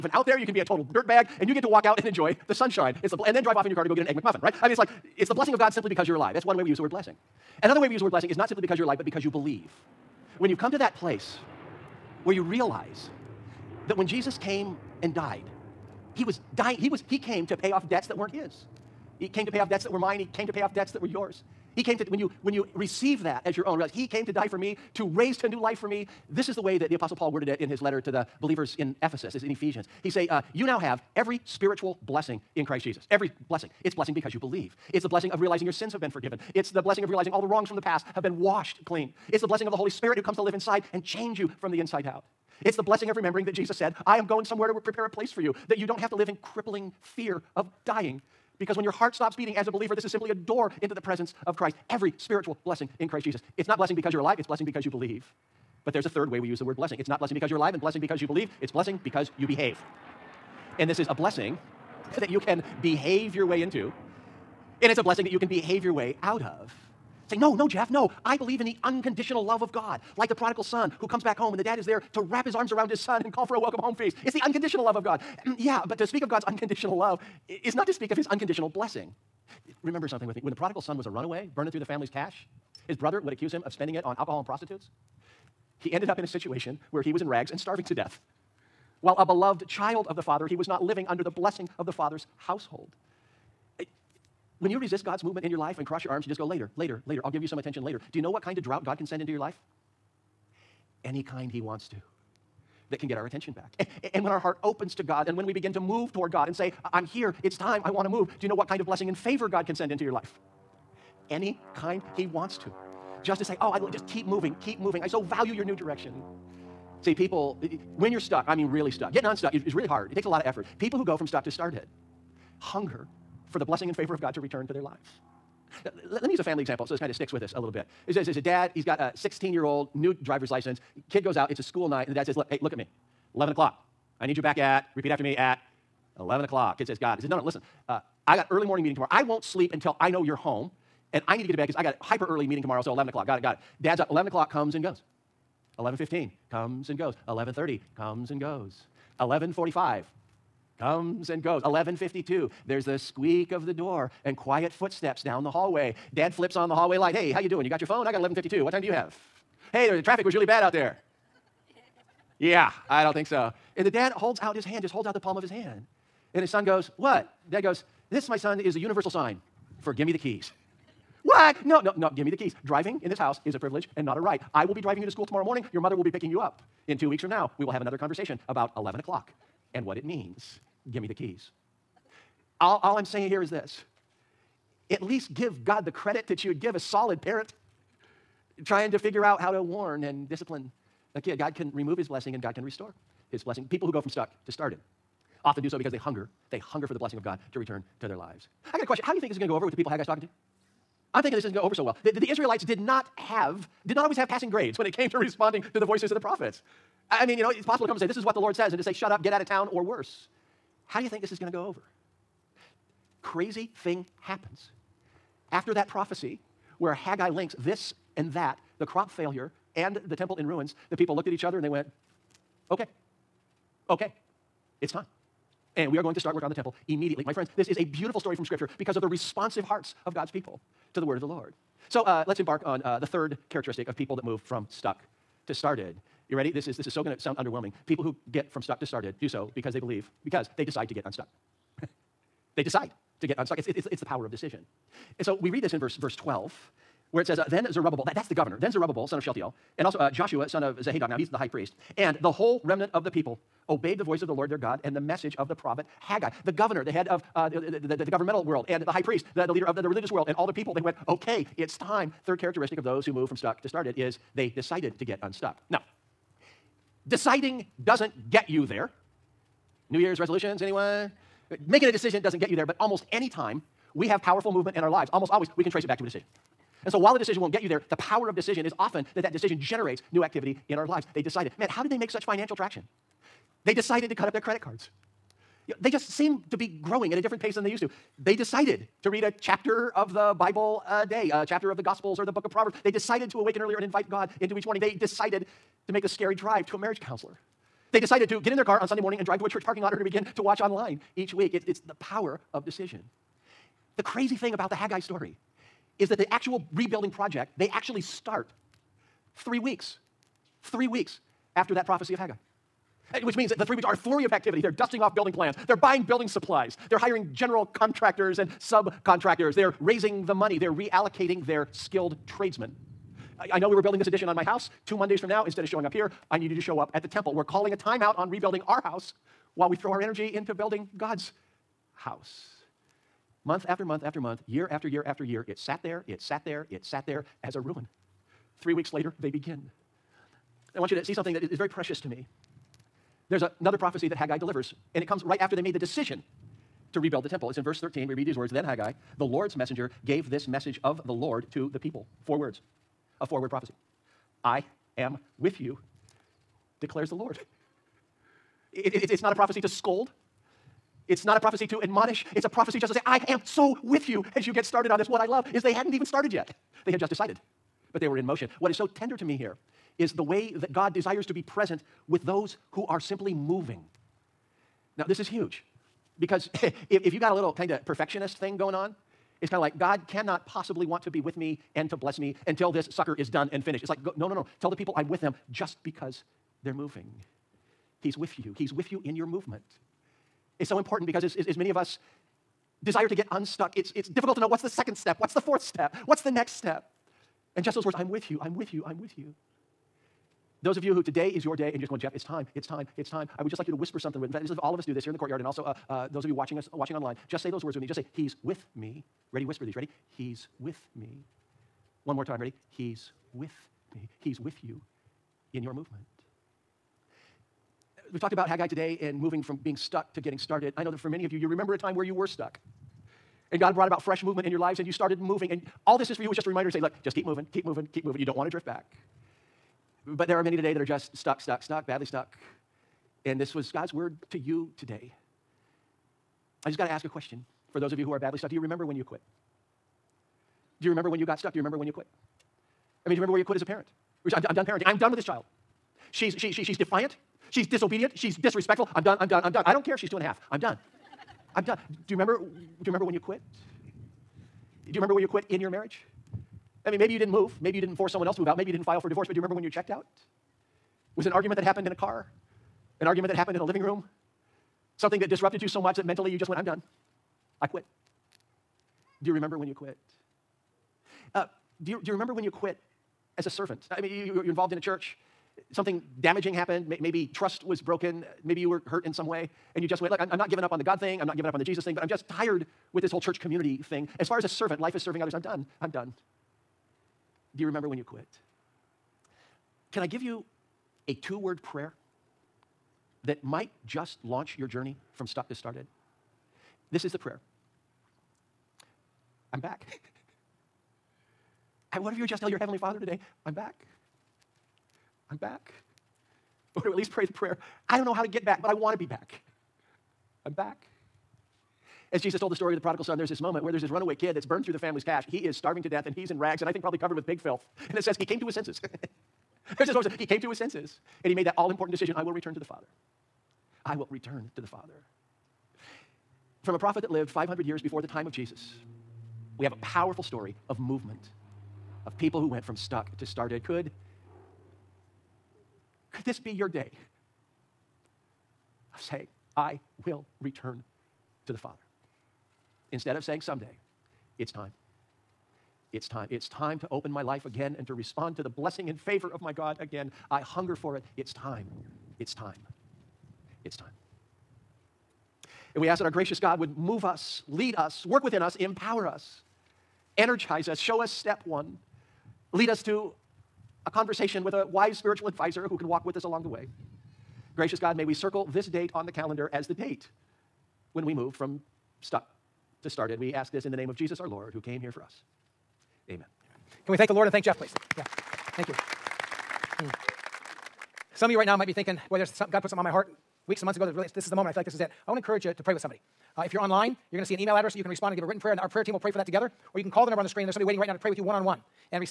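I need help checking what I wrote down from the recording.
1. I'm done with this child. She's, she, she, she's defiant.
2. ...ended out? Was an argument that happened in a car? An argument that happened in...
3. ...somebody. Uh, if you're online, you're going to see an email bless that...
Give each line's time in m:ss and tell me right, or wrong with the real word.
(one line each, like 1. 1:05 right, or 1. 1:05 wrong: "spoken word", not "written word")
1. 7:24 right
2. 7:39 wrong: "checked", not "ended"
3. 9:45 wrong: "address", not "bless".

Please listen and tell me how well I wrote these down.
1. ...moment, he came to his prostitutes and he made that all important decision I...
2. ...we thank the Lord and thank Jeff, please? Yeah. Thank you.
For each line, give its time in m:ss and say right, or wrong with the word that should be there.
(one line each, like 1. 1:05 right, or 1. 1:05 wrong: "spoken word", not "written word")
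1. 8:39 wrong: "senses", not "prostitutes"
2. 9:36 right.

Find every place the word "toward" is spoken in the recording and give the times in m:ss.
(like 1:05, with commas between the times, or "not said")
1:46.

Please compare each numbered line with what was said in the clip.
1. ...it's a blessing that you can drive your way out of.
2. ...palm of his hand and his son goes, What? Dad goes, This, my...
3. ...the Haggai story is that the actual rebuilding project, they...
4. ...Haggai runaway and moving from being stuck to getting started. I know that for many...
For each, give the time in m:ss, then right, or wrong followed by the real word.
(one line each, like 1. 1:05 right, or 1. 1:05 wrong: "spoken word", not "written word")
1. 1:04 wrong: "behave", not "drive"
2. 2:45 right
3. 5:04 right
4. 6:58 wrong: "today", not "runaway".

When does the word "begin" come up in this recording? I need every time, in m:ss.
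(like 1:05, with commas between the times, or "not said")
1:45, 5:00, 5:39.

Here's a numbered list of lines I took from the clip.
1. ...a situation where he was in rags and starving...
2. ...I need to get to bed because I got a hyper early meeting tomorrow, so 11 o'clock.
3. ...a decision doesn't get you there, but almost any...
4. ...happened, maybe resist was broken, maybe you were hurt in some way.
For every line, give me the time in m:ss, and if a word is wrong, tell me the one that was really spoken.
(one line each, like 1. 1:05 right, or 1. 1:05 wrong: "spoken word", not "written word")
1. 1:26 right
2. 2:21 right
3. 4:31 right
4. 7:56 wrong: "trust", not "resist".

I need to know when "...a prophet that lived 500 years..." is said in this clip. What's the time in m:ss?
8:46.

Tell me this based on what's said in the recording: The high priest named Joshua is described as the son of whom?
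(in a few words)
Jozadak.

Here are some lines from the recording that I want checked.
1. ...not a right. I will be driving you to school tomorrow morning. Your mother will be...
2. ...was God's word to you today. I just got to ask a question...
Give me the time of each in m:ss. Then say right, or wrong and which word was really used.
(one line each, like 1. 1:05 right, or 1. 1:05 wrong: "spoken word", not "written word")
1. 2:54 right
2. 7:13 right.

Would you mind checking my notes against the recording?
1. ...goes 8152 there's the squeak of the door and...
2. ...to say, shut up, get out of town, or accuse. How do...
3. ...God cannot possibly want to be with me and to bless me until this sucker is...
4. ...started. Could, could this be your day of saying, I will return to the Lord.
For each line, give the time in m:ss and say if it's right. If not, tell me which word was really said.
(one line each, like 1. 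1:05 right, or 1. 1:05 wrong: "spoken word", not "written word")
1. 2:31 wrong: "1152", not "8152"
2. 3:28 wrong: "worse", not "accuse"
3. 6:19 right
4. 8:53 wrong: "Father", not "Lord".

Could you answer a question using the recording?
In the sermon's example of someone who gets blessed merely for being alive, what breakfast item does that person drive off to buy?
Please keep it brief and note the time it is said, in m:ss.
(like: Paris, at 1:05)
Egg McMuffin, at 0:04.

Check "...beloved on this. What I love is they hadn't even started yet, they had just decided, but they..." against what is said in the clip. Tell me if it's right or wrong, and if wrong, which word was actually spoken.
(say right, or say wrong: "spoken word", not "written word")
wrong: "started", not "beloved".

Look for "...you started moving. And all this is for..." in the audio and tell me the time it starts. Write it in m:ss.
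7:04.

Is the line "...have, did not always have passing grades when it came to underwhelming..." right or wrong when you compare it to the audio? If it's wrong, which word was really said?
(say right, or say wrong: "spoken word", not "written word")
wrong: "responding", not "underwhelming".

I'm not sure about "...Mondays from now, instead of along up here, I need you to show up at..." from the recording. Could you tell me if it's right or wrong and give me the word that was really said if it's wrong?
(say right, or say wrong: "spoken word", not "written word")
wrong: "showing", not "along".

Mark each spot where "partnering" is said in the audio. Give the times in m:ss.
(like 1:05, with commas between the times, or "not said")
not said.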